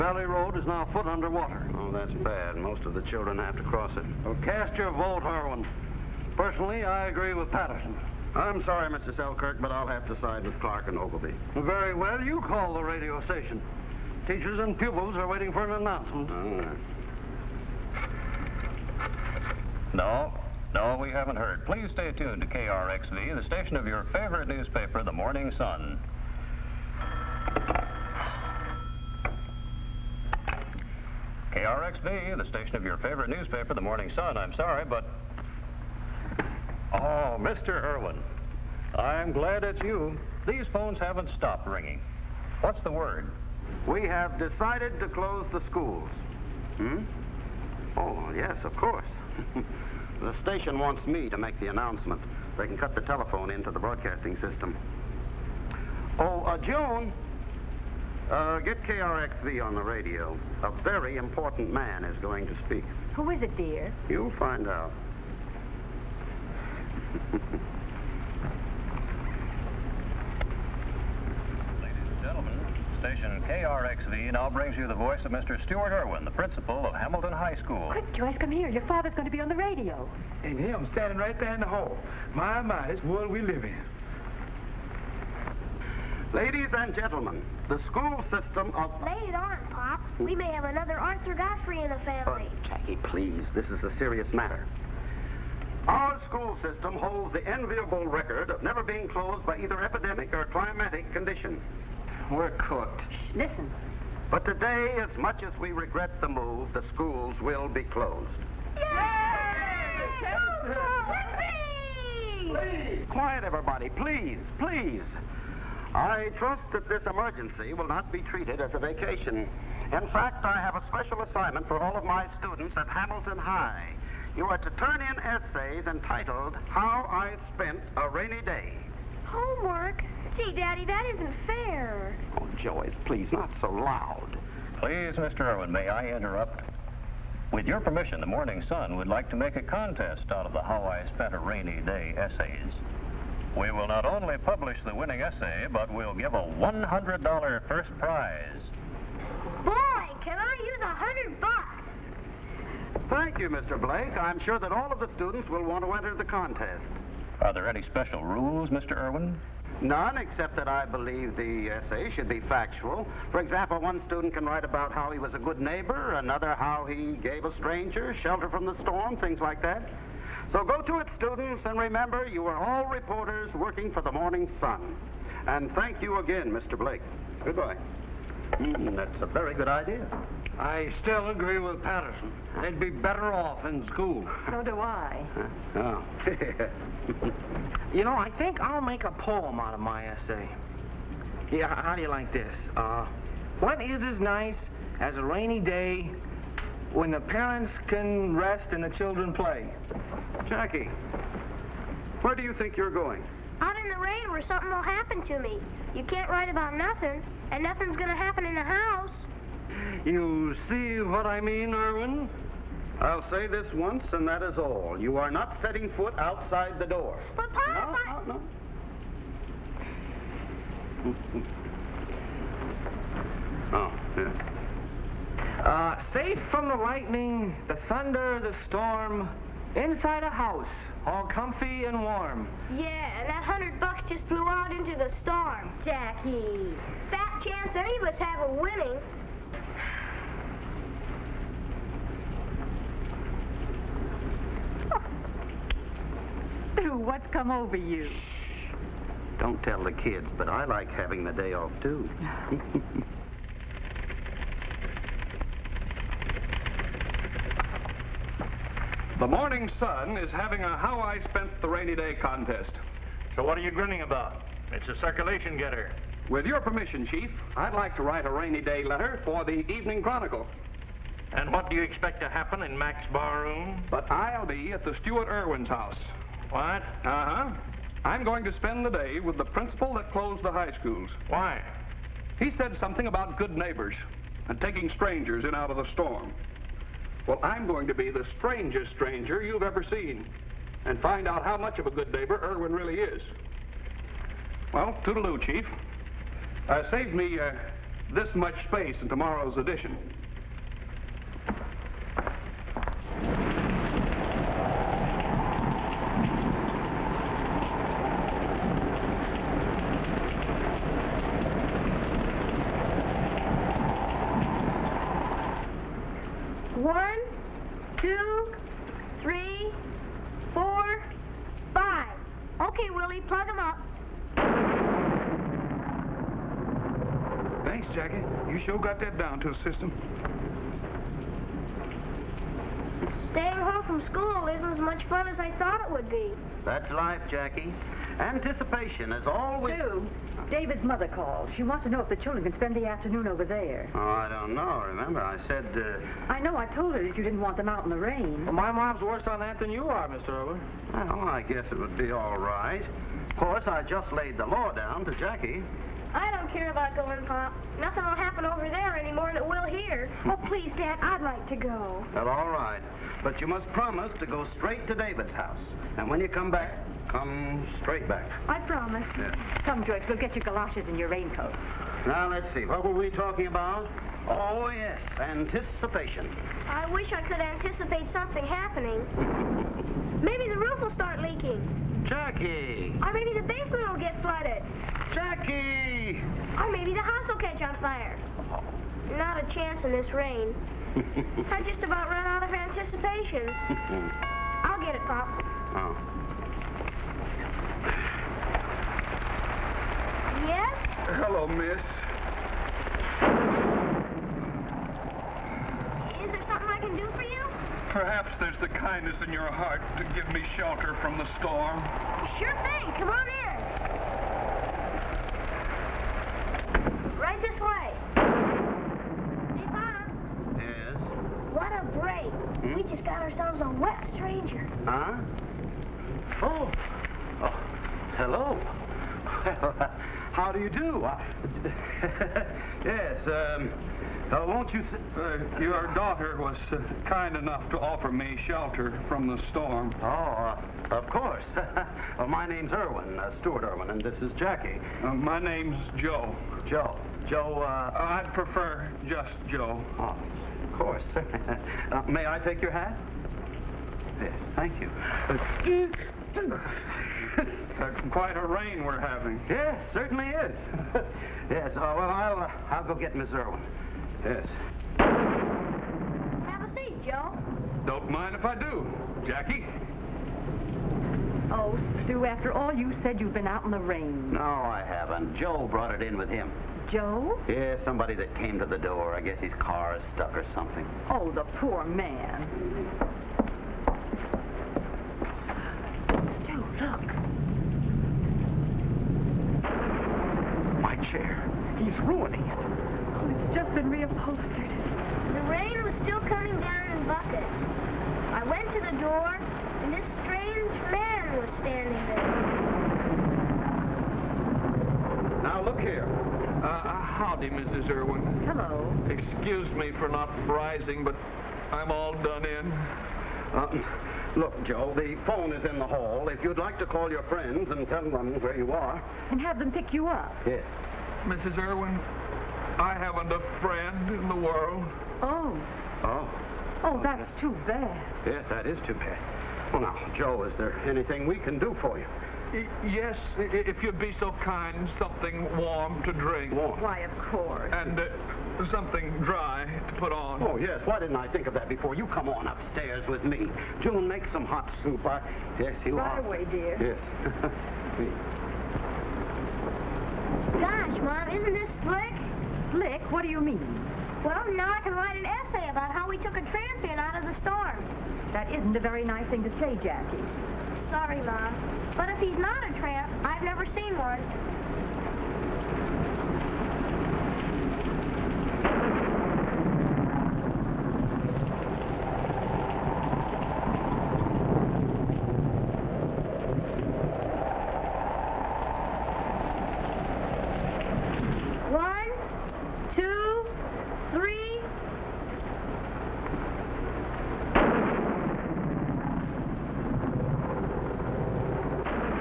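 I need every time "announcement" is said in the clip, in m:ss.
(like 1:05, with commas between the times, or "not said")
0:15, 0:51.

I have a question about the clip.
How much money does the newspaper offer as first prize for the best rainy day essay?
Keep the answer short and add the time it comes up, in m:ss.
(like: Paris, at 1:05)
$100, at 2:26.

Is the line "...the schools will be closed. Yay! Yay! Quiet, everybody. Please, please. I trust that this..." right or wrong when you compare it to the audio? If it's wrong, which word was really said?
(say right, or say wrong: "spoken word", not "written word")
right.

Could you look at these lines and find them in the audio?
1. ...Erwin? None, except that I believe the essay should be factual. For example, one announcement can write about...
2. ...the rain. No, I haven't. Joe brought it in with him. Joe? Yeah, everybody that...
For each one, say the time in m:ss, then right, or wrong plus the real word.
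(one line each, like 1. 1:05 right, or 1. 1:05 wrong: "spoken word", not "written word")
1. 2:38 wrong: "student", not "announcement"
2. 7:53 wrong: "somebody", not "everybody".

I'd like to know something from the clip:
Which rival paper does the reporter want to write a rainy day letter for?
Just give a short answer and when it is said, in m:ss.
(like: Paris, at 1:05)
Evening Chronicle, at 4:29.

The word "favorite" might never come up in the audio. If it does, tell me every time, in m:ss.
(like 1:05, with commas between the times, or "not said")
0:24, 0:32.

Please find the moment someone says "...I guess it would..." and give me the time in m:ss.
5:51.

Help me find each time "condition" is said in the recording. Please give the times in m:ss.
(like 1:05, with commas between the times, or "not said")
1:41.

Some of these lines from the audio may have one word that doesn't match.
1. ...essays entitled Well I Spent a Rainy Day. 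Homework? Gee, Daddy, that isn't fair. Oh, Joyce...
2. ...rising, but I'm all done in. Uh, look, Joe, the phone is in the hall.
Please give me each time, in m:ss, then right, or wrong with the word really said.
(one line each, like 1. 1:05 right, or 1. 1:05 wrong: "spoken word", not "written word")
1. 2:05 wrong: "How", not "Well"
2. 8:30 right.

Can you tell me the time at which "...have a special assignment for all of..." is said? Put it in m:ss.
2:00.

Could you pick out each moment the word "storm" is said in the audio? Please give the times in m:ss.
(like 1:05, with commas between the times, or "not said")
2:48, 3:48, 3:55, 4:45, 6:51, 7:19, 9:17.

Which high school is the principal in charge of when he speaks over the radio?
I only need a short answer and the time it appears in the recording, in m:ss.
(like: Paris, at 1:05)
Hamilton High School, at 1:16.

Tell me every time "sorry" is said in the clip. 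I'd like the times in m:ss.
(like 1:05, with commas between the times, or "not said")
0:08, 0:34, 9:20.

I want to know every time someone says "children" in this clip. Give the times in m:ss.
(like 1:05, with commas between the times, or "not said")
0:03, 3:18, 5:42.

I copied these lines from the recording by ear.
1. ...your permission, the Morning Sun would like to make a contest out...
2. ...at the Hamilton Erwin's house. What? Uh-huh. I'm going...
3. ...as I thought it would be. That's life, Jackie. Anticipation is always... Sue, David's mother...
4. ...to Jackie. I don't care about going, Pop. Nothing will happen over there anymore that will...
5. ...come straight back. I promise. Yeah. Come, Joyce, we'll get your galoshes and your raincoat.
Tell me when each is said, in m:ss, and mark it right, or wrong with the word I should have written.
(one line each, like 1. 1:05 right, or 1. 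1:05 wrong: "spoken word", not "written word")
1. 2:17 right
2. 4:34 wrong: "Stuart", not "Hamilton"
3. 5:35 right
4. 5:55 right
5. 6:07 wrong: "George", not "Joyce".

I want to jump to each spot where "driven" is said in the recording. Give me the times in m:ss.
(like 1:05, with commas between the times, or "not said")
not said.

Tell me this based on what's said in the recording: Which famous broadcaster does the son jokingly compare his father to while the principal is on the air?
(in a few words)
Arthur Godfrey.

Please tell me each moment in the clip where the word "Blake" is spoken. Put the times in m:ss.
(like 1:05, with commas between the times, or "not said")
2:33, 2:56.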